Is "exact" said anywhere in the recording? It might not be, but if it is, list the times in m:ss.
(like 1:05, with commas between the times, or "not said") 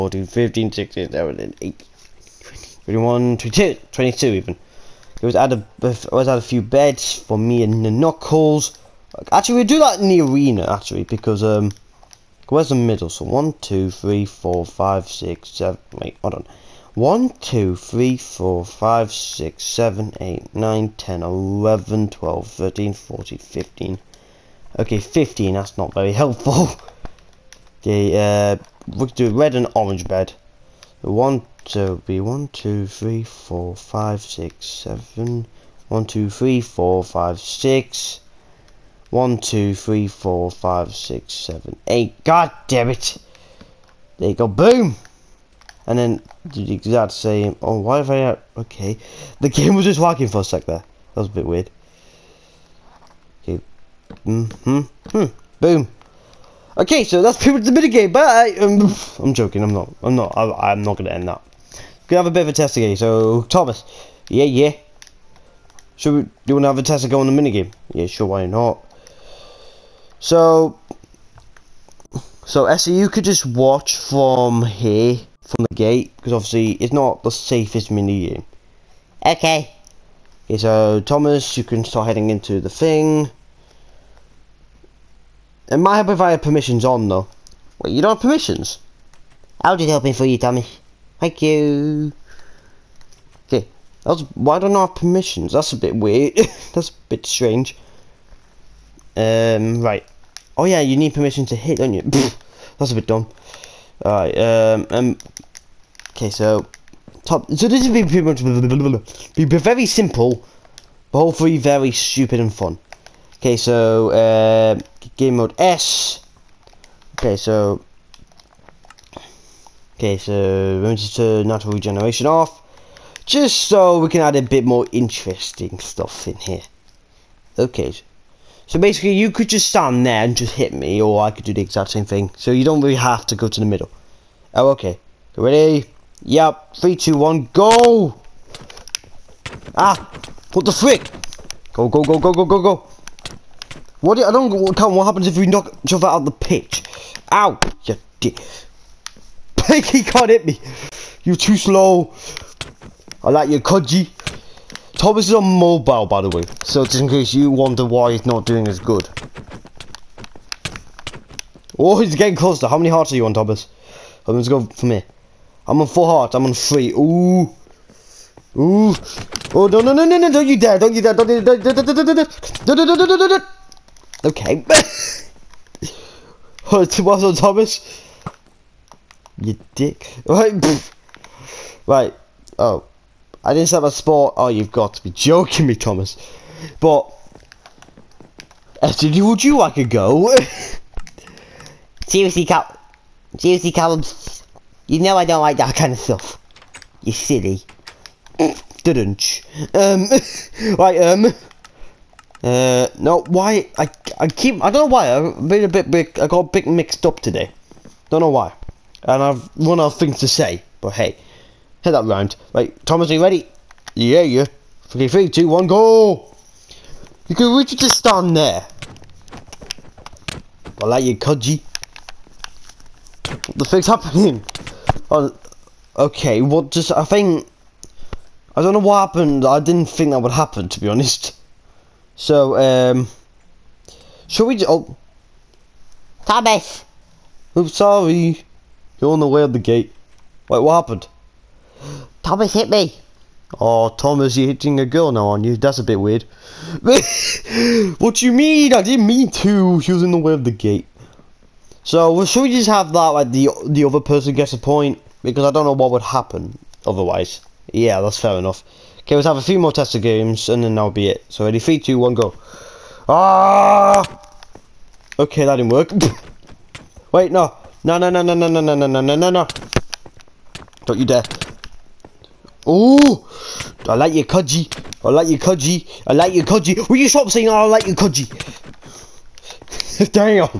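0:46, 2:11.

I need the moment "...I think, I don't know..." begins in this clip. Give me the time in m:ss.
3:46.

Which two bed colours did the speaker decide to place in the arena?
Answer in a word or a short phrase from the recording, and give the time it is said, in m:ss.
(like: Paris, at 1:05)
red and orange, at 0:29.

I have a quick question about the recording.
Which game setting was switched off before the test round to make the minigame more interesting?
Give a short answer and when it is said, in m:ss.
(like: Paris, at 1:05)
natural regeneration, at 2:01.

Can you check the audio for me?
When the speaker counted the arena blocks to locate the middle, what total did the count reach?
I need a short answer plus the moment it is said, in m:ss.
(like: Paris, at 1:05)
15, at 0:24.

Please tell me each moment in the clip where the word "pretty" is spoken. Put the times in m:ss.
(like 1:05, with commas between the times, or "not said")
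0:57, 1:48.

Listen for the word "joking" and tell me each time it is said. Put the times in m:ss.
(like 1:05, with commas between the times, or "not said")
0:59, 3:05.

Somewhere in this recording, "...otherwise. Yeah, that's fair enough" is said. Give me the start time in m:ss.
4:16.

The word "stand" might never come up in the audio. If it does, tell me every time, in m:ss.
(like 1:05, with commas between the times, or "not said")
2:09, 3:37.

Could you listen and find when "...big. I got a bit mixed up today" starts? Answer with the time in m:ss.
3:25.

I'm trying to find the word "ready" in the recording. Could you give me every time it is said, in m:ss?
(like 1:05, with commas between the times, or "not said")
2:15, 3:33, 4:21.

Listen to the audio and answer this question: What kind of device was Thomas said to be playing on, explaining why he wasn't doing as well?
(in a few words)
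mobile.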